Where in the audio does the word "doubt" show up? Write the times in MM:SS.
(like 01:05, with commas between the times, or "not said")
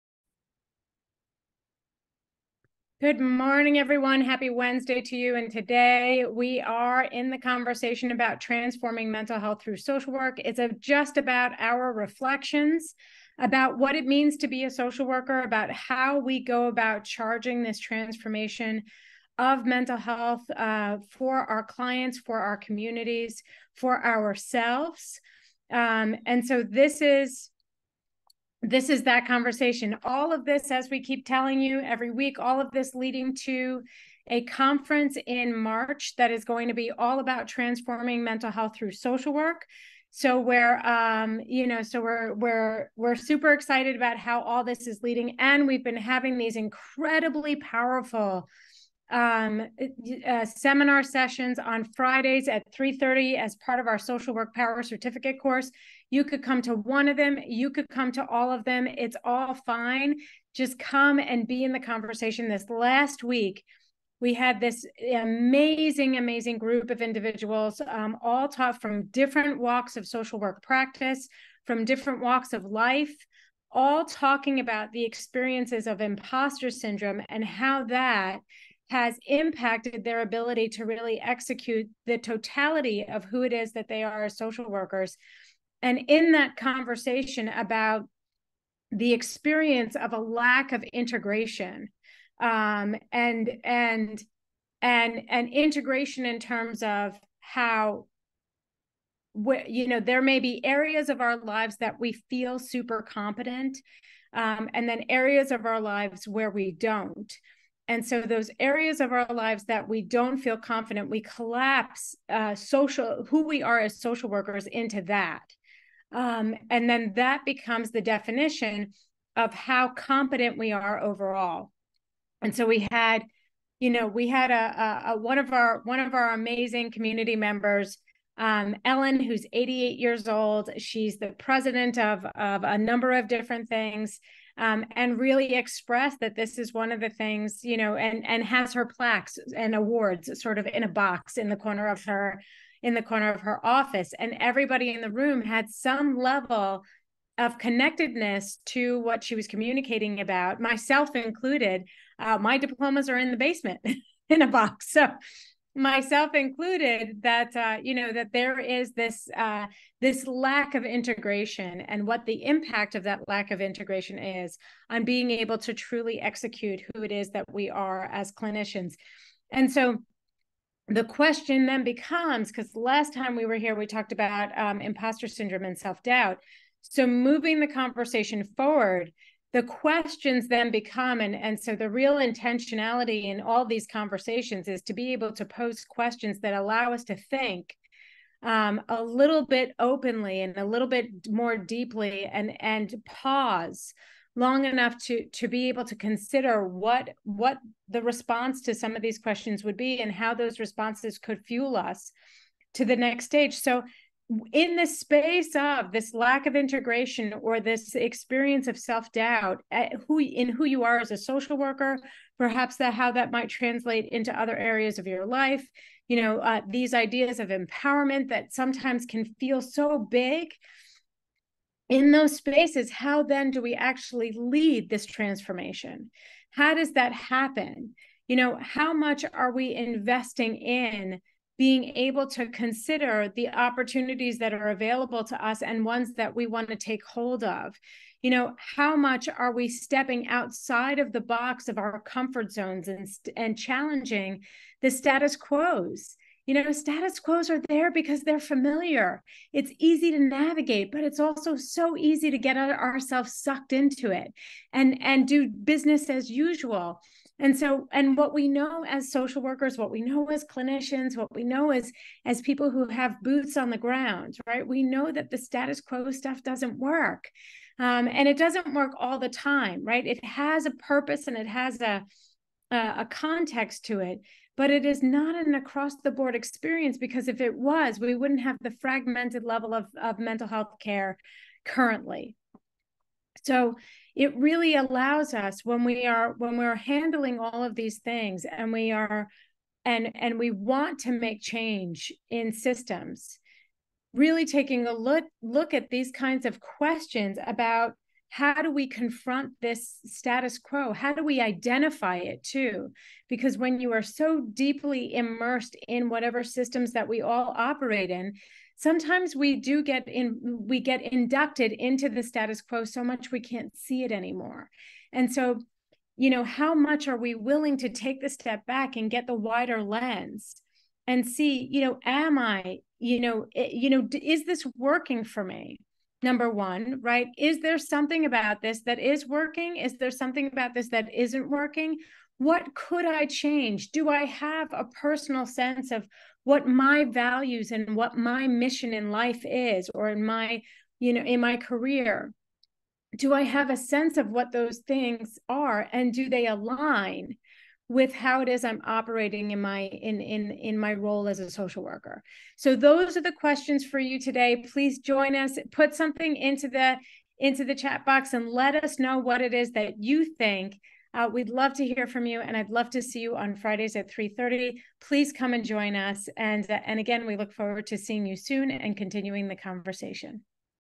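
02:55, 03:28.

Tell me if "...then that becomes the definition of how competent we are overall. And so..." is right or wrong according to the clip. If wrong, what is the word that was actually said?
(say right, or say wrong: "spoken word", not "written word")
right.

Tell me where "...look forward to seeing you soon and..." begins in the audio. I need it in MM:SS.
06:07.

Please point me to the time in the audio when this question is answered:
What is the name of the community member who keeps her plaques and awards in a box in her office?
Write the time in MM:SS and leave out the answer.
02:08.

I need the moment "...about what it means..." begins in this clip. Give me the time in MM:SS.
00:13.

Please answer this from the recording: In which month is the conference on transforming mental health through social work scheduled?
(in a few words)
March.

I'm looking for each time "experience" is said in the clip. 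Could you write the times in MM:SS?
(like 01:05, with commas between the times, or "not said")
01:15, 01:29, 03:27, 04:36.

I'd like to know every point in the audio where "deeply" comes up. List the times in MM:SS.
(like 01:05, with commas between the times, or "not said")
03:11, 05:04.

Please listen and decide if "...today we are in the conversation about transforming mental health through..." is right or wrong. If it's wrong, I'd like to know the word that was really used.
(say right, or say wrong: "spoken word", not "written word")
right.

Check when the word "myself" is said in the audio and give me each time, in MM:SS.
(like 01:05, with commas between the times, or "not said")
02:30, 02:35.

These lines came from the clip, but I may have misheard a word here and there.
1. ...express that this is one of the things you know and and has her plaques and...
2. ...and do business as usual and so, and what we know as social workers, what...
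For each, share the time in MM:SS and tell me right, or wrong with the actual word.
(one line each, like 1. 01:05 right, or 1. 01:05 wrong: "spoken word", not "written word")
1. 02:15 right
2. 04:14 right.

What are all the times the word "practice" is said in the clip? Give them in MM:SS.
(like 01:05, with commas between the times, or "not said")
01:10.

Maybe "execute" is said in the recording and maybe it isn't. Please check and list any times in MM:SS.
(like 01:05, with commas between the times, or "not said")
01:21, 02:46.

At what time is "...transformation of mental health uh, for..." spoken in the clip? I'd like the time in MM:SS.
00:17.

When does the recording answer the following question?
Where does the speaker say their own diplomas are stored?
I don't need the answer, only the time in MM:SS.
02:33.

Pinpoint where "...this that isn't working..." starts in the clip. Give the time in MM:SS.
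05:30.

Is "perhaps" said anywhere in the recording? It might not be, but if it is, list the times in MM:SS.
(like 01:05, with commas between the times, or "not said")
03:32.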